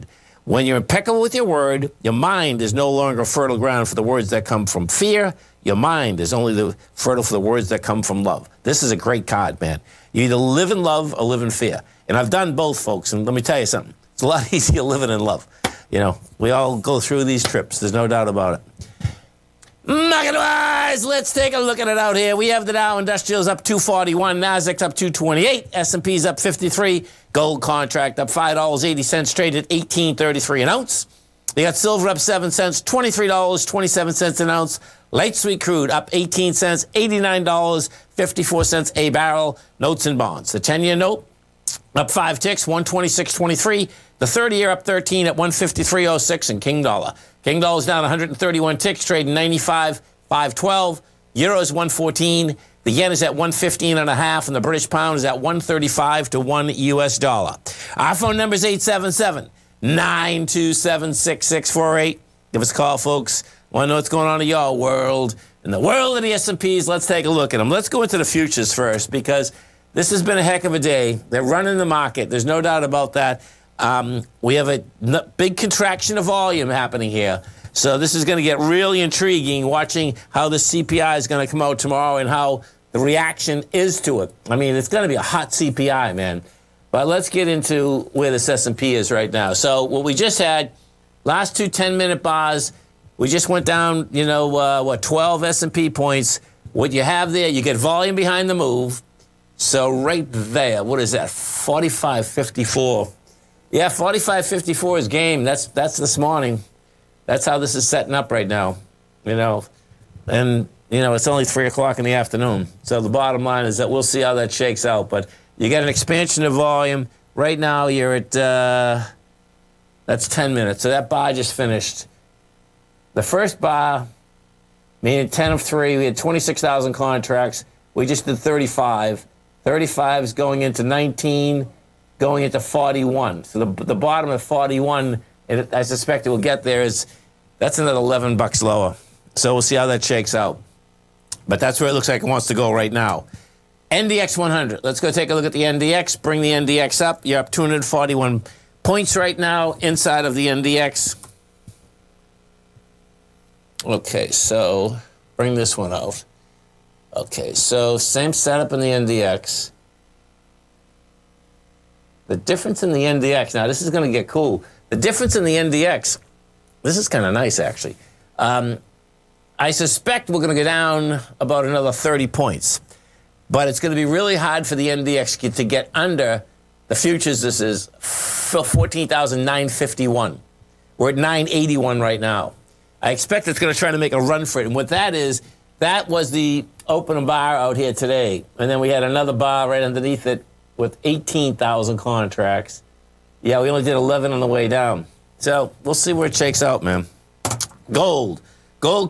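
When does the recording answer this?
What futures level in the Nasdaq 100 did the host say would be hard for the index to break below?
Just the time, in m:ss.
2:57.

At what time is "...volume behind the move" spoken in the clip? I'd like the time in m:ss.
1:37.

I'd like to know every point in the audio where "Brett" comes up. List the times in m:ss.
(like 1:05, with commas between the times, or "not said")
not said.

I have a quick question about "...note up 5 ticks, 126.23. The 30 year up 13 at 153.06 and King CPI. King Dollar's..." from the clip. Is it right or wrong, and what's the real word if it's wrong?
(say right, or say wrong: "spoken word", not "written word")
wrong: "Dollar", not "CPI".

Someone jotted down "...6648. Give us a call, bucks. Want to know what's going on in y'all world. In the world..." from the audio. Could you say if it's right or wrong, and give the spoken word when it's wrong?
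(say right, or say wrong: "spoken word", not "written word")
wrong: "folks", not "bucks".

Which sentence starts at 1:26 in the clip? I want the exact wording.
But let's get into where this S&P is right now.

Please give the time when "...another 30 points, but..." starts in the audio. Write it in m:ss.
2:51.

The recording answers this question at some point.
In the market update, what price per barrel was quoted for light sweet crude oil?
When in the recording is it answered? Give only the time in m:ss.
0:36.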